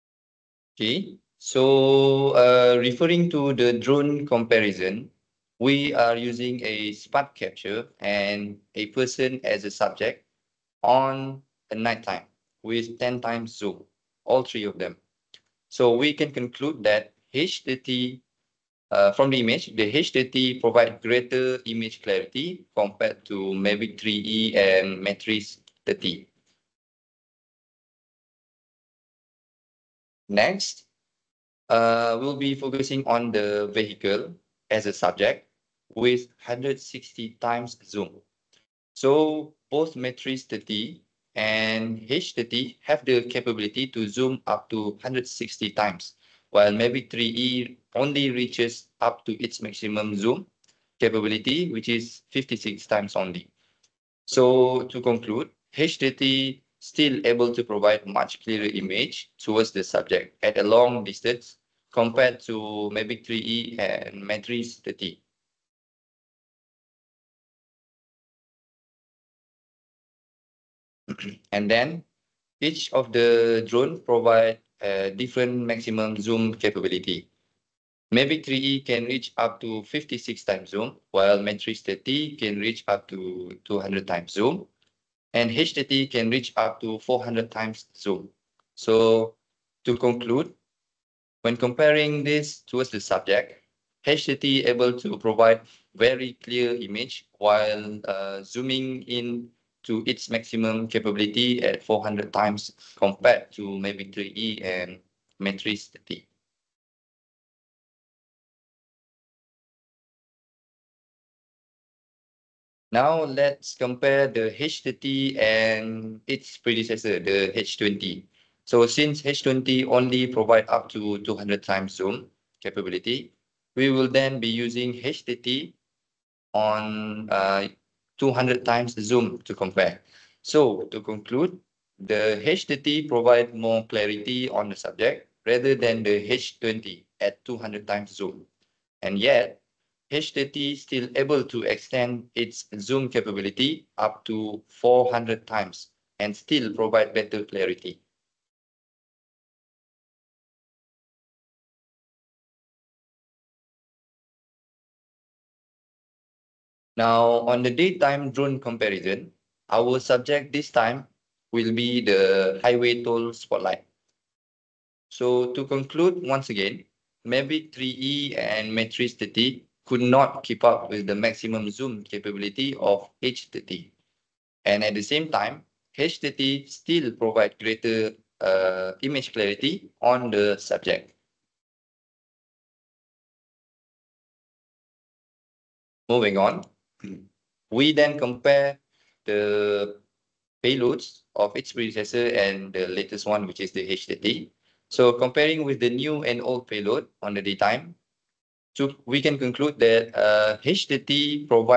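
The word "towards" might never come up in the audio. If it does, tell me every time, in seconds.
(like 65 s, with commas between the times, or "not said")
59 s, 92 s.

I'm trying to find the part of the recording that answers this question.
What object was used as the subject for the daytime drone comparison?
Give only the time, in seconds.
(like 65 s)
162 s.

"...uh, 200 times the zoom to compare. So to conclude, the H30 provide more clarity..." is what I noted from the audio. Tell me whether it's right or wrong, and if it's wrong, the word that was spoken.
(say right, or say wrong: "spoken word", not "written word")
right.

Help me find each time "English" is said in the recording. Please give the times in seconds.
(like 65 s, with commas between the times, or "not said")
not said.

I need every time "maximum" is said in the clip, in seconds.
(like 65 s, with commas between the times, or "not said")
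49 s, 75 s, 100 s, 171 s.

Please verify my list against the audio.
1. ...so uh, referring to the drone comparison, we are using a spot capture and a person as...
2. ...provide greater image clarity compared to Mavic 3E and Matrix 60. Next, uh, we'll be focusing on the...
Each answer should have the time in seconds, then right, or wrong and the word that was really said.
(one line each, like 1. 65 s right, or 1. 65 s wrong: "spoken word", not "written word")
1. 1 s right
2. 20 s wrong: "30", not "60".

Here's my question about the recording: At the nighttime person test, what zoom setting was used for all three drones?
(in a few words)
10x.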